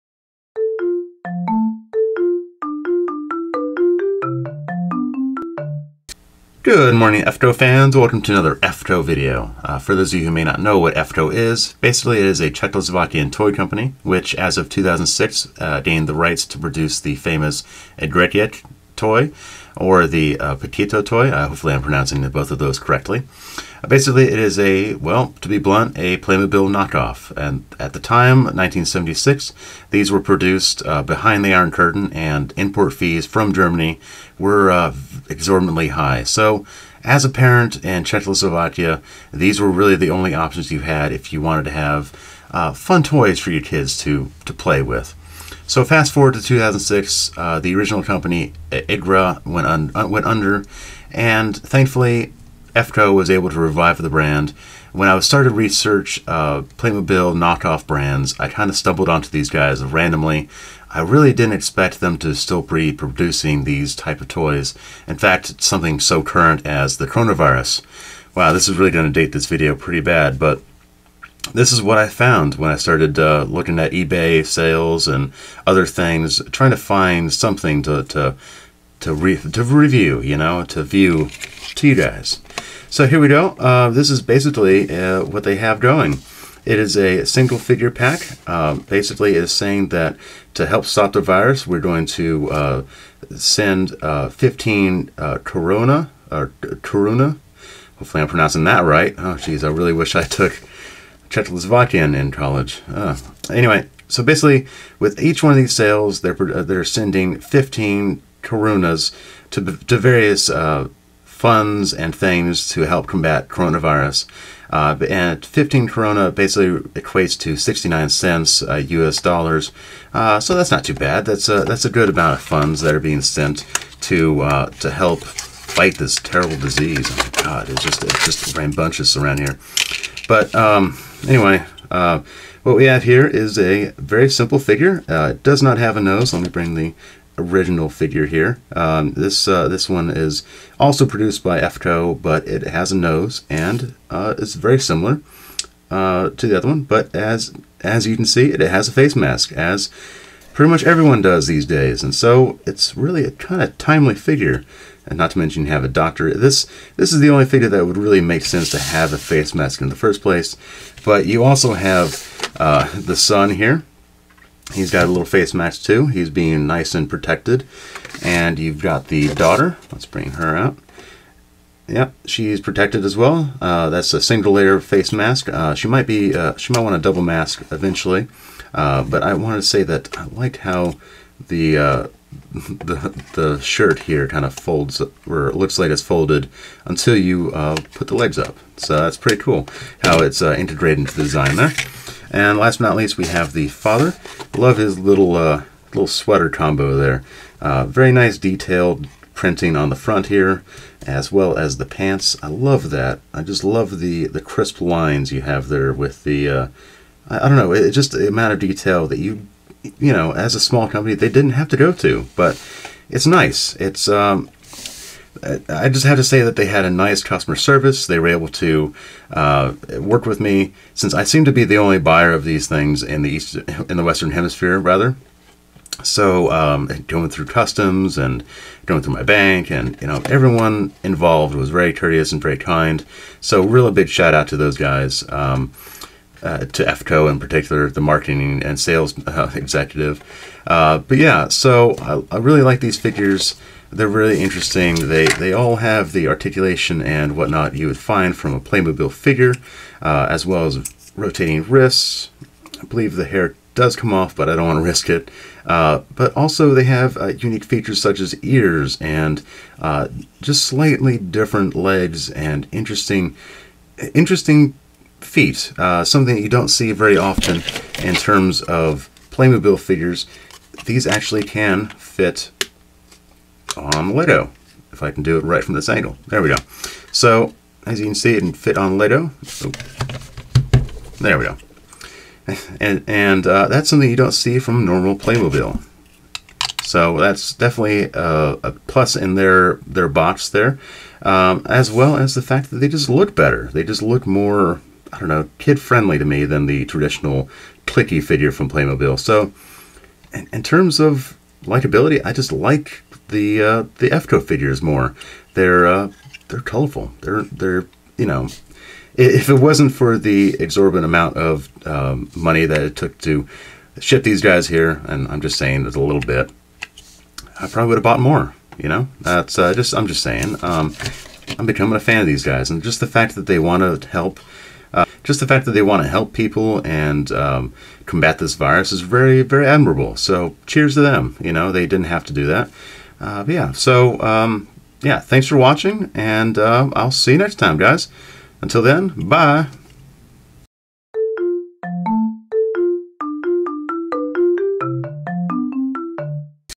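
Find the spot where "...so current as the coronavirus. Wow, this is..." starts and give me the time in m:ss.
1:06.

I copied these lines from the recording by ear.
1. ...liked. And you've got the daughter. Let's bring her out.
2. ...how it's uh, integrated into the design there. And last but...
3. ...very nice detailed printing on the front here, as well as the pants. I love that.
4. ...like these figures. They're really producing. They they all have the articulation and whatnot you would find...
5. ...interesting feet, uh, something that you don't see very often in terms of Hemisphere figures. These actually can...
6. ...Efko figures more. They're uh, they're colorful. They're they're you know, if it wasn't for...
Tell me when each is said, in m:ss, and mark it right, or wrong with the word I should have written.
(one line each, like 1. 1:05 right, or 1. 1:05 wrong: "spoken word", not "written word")
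1. 2:47 wrong: "protected", not "liked"
2. 3:10 right
3. 3:17 right
4. 4:02 wrong: "interesting", not "producing"
5. 4:24 wrong: "Playmobil", not "Hemisphere"
6. 5:04 right.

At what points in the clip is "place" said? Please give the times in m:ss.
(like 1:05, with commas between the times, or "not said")
2:40.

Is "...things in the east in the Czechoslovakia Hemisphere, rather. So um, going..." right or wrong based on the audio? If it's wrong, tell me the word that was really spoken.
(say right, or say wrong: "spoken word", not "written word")
wrong: "Western", not "Czechoslovakia".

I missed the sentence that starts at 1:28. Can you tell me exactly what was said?
Um, basically, is saying that to help stop the virus, we're going to uh, send uh, 15 uh, Corona or Corona.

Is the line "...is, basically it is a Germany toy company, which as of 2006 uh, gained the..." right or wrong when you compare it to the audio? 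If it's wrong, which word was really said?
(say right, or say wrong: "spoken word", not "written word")
wrong: "Czechoslovakian", not "Germany".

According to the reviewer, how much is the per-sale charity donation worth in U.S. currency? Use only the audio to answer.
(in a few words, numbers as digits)
69 cents.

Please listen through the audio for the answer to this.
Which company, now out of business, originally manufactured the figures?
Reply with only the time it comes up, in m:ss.
0:48.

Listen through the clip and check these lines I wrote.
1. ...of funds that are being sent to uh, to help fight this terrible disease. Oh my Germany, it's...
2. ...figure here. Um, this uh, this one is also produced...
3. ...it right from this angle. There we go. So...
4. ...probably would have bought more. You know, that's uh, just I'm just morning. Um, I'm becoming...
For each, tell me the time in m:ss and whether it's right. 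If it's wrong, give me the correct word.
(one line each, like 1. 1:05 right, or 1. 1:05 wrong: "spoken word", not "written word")
1. 2:02 wrong: "God", not "Germany"
2. 2:17 right
3. 4:35 right
4. 5:17 wrong: "saying", not "morning".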